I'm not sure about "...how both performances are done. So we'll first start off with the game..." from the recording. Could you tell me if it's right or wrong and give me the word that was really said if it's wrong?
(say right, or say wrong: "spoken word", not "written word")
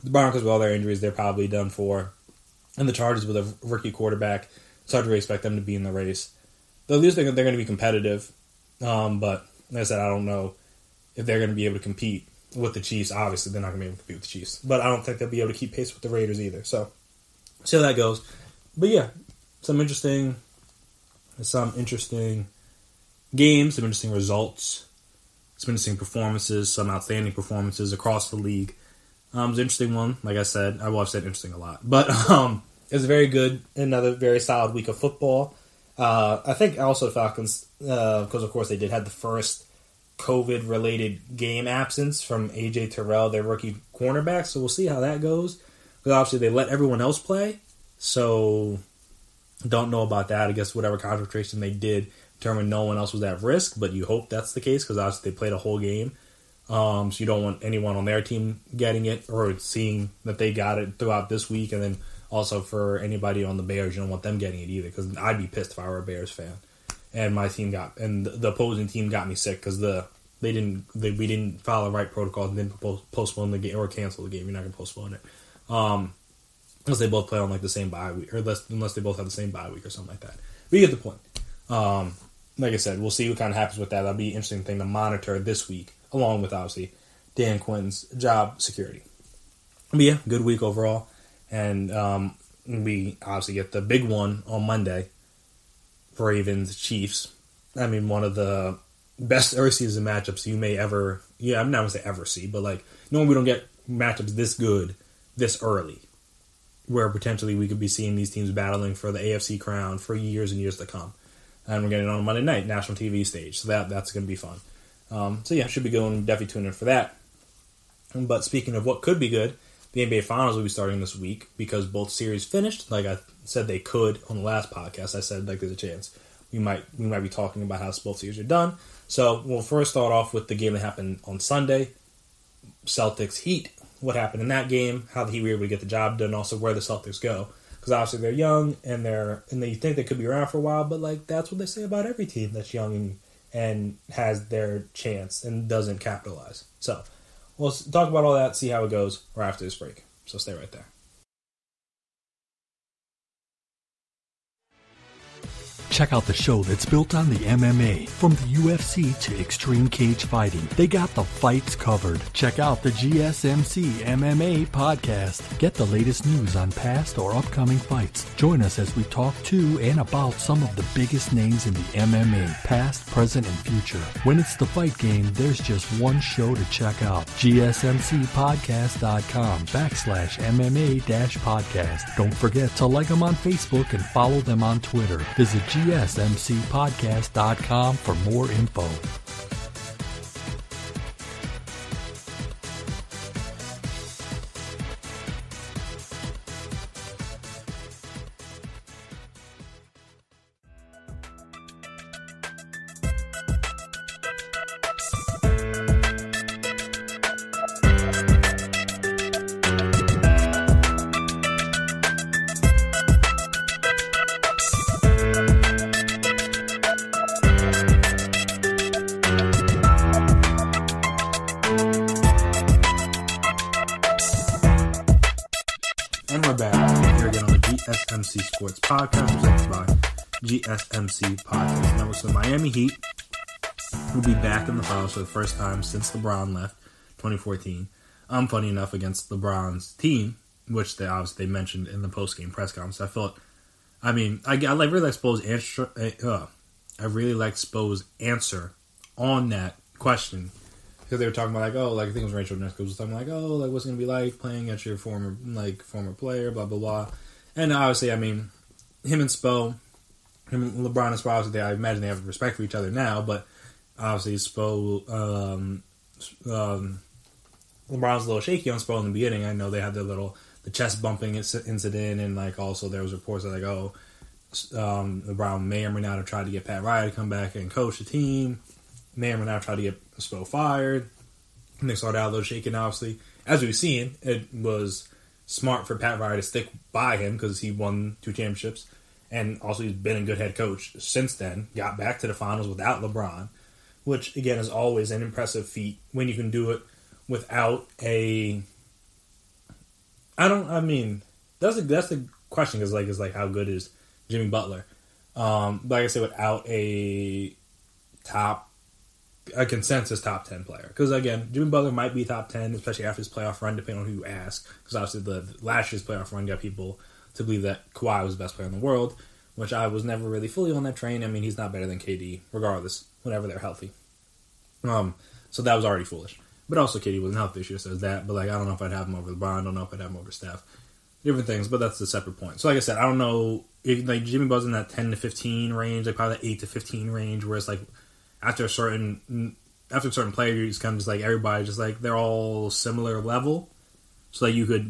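wrong: "series", not "performances".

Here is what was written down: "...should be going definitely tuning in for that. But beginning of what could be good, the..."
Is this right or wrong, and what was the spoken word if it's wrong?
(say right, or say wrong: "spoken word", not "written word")
wrong: "speaking", not "beginning".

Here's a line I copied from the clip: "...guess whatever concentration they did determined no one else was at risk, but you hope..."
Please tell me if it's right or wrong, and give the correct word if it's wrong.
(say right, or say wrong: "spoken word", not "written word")
right.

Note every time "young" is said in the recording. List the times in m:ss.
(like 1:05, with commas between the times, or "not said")
2:18, 2:22.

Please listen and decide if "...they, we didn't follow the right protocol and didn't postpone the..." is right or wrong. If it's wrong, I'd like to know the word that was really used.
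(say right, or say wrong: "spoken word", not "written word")
right.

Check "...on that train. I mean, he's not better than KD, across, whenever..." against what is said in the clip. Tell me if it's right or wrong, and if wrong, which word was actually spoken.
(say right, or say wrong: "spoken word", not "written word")
wrong: "regardless", not "across".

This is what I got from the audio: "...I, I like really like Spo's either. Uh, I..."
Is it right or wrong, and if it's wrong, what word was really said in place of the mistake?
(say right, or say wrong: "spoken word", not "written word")
wrong: "answer", not "either".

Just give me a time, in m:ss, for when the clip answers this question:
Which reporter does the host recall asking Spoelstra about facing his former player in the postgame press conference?
4:12.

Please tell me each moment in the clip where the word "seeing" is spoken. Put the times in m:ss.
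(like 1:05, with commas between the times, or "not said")
0:59, 1:47.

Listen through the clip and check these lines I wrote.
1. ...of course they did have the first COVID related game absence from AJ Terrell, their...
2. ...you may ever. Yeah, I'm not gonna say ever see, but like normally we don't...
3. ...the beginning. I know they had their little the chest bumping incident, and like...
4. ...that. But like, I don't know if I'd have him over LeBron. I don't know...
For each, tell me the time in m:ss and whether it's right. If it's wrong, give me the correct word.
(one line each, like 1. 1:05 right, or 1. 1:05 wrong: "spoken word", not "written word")
1. 0:38 right
2. 1:40 right
3. 4:29 right
4. 5:27 right.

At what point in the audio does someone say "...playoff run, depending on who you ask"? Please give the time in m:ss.
5:13.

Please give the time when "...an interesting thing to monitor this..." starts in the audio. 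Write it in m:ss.
1:24.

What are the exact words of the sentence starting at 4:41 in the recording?
And they started out a little shaken, obviously.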